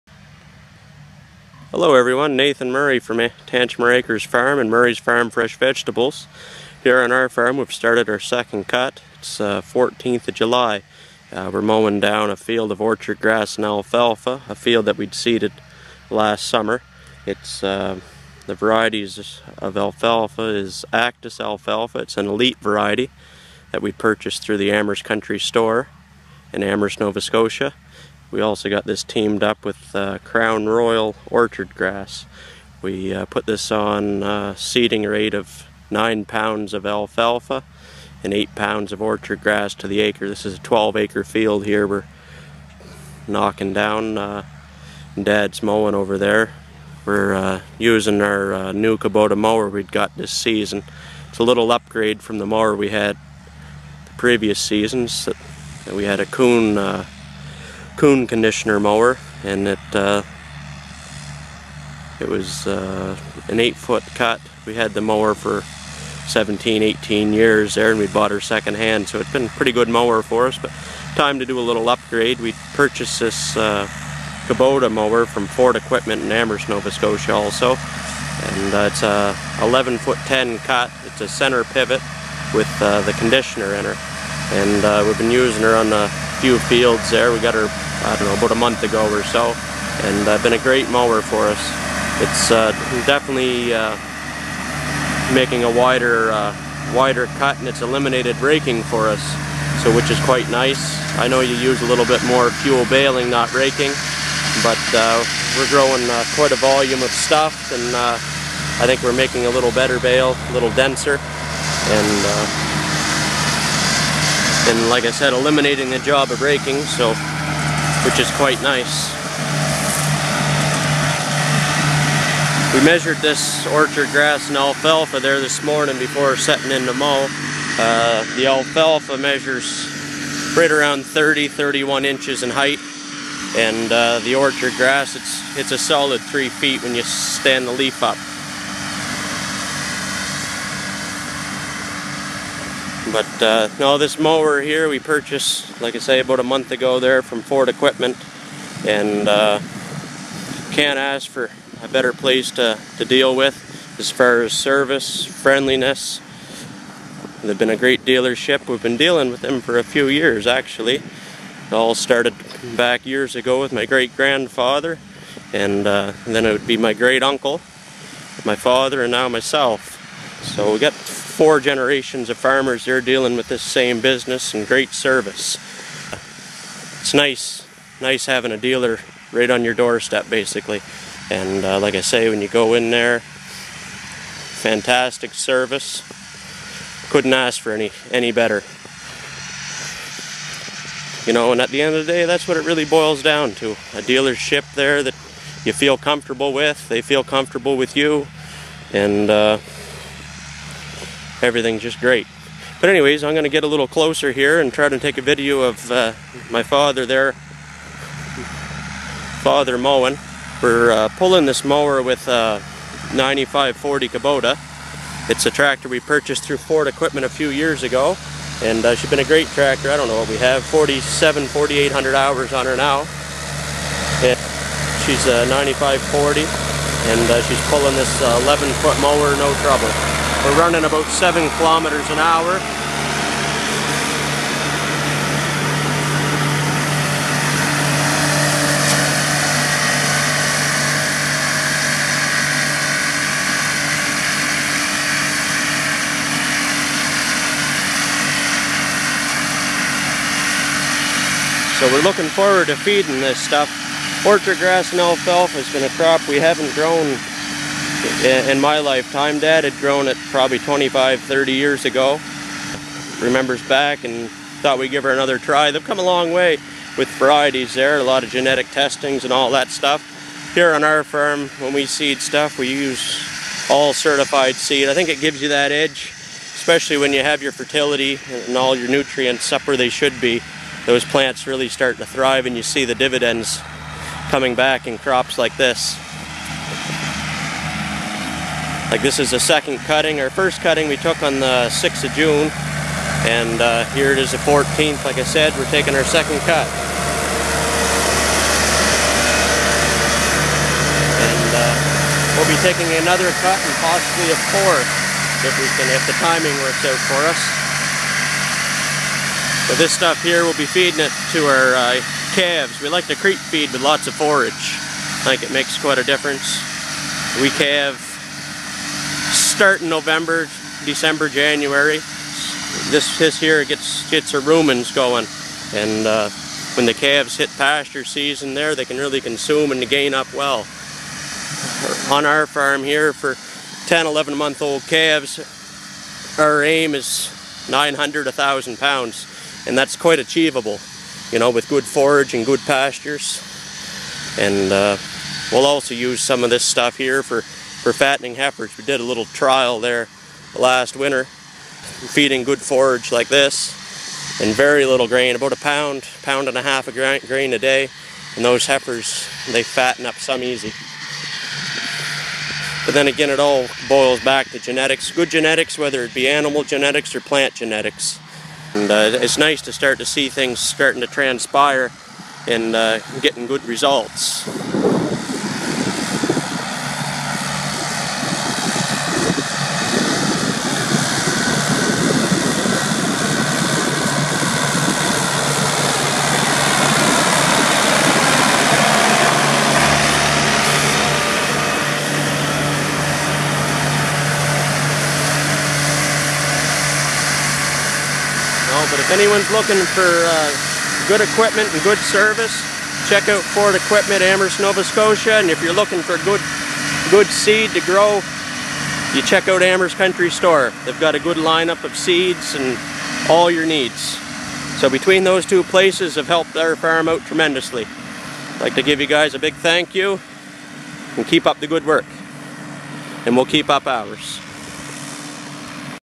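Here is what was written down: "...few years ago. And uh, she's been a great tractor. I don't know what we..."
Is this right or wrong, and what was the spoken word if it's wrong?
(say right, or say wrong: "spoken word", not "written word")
right.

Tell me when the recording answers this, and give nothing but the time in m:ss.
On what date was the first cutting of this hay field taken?
4:51.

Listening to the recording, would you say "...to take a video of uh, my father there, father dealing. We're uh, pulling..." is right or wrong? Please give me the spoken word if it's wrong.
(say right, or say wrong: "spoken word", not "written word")
wrong: "mowing", not "dealing".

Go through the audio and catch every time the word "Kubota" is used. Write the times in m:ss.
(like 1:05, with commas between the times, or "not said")
0:48, 1:14, 3:34.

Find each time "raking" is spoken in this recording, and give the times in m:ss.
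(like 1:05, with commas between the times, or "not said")
1:38, 1:43, 1:56.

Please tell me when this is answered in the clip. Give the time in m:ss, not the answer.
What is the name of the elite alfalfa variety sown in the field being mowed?
0:20.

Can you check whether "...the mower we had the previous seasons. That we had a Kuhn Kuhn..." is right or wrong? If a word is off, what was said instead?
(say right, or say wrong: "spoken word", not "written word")
right.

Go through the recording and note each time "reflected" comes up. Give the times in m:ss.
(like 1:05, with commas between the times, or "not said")
not said.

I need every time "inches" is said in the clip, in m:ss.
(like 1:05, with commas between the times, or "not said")
2:12.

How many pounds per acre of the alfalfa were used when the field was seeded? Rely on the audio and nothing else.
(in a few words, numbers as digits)
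9 pounds.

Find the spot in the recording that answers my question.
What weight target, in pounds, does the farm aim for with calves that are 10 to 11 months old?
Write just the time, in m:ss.
5:37.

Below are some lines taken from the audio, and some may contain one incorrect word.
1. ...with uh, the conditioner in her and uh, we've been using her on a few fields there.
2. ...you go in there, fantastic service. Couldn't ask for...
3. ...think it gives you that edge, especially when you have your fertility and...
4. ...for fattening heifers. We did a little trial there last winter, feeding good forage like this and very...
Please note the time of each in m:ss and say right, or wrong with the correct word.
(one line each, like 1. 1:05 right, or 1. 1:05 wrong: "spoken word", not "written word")
1. 1:22 right
2. 3:02 right
3. 4:34 right
4. 5:47 right.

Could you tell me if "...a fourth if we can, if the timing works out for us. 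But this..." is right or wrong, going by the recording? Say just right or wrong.
right.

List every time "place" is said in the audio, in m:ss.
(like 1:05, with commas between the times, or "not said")
2:32, 6:55.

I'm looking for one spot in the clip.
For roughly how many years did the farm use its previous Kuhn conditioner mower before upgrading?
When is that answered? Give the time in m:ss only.
1:06.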